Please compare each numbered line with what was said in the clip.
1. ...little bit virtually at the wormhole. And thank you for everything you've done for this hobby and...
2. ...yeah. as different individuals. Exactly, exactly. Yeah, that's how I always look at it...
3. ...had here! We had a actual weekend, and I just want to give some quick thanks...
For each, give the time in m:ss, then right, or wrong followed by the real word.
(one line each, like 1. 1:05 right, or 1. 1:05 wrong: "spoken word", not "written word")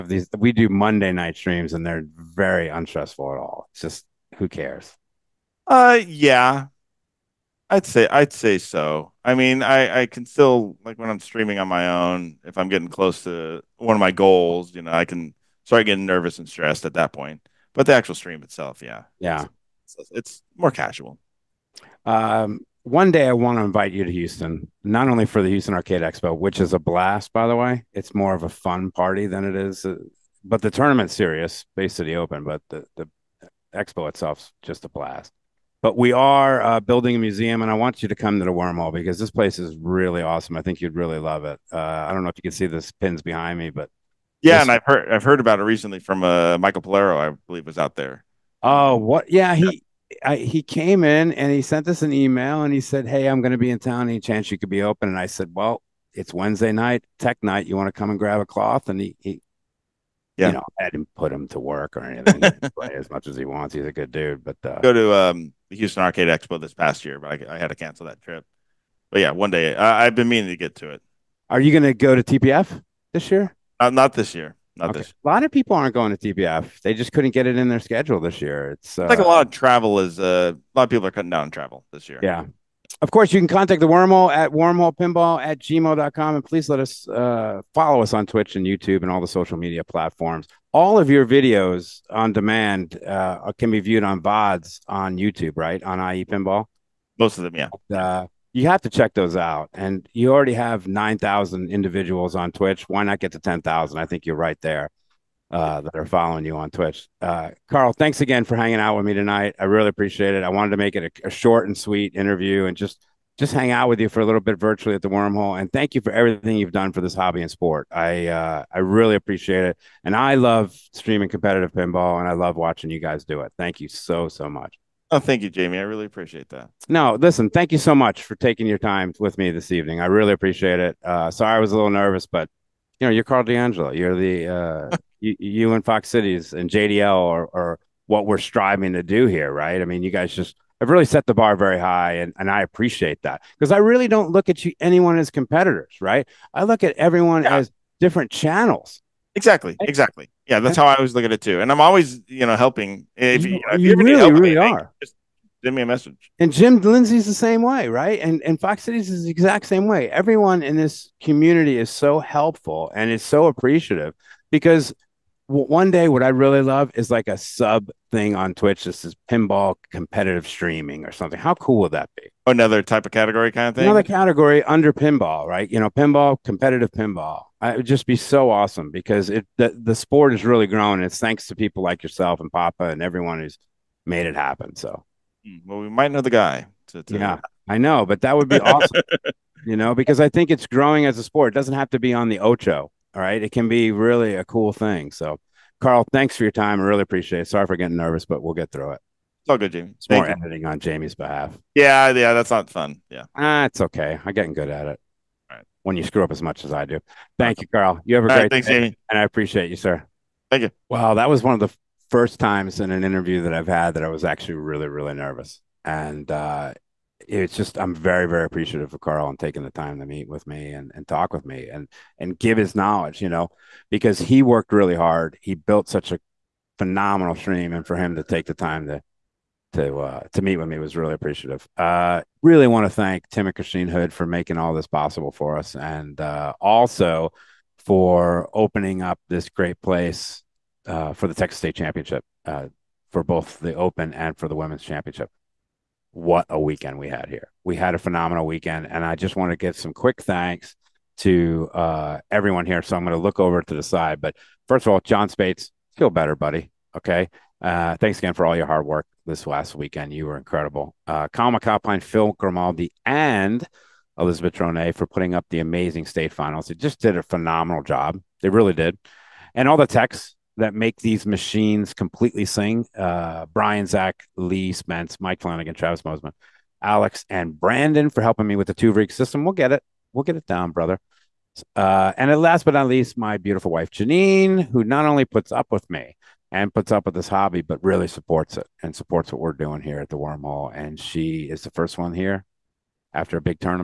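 1. 1:54 right
2. 2:27 wrong: "channels", not "individuals"
3. 4:07 wrong: "phenomenal", not "actual".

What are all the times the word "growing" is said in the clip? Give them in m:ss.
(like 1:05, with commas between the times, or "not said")
3:00, 3:10.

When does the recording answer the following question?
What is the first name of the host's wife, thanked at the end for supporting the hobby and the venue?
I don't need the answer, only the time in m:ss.
4:43.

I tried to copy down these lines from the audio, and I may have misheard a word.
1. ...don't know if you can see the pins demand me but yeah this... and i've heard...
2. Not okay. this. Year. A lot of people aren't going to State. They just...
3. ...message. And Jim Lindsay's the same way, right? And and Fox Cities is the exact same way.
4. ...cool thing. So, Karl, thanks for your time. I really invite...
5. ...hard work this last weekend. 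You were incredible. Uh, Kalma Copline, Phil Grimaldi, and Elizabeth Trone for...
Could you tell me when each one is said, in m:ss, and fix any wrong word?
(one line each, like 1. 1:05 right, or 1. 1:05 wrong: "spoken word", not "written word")
1. 0:42 wrong: "behind", not "demand"
2. 1:14 wrong: "TPF", not "State"
3. 2:35 right
4. 3:14 wrong: "appreciate", not "invite"
5. 4:18 right.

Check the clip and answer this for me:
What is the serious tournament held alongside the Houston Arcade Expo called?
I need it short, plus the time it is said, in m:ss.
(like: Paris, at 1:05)
Space City Open, at 0:31.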